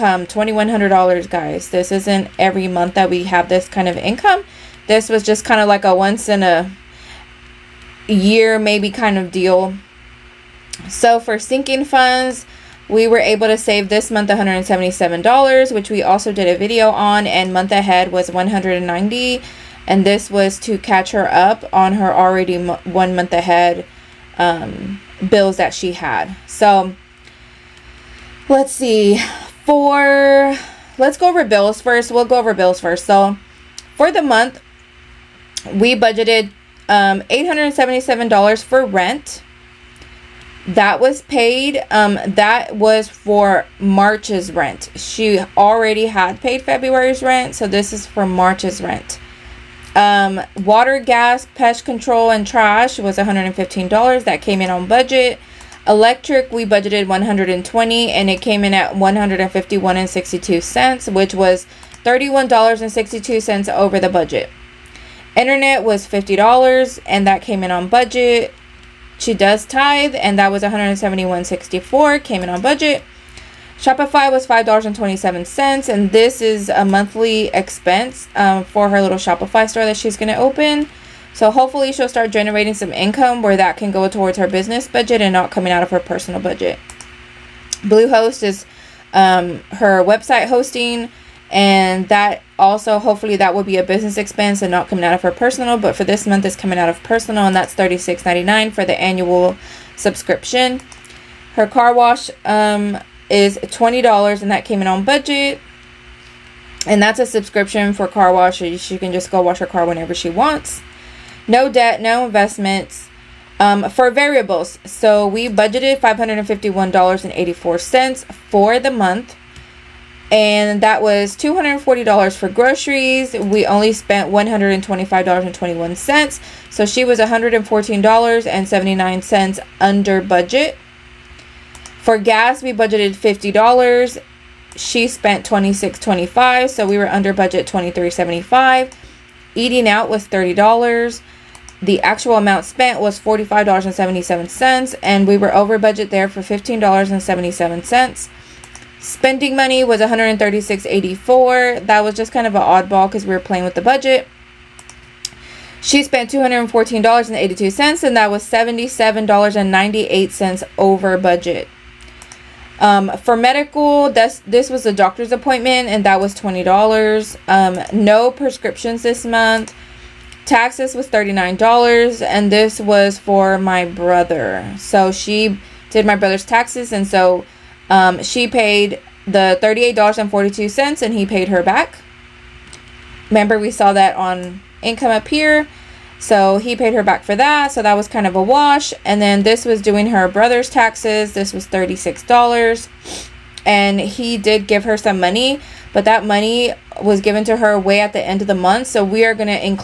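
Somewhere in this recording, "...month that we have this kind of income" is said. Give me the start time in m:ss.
0:02.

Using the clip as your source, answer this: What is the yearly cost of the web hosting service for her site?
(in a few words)
$36.99.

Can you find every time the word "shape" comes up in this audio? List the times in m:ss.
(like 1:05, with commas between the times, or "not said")
not said.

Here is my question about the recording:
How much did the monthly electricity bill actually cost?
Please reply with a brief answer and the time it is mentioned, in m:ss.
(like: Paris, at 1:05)
$151.62, at 0:58.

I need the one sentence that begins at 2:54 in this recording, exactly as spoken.
So she did my brother's taxes and so um, she paid the $38.42 and he paid her back.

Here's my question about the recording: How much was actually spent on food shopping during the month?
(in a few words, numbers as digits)
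$125.21.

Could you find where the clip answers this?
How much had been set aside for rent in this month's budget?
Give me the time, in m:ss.
0:37.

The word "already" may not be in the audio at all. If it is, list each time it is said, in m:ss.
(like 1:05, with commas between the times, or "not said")
0:22, 0:45.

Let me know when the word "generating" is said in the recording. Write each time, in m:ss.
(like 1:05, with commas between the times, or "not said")
1:22.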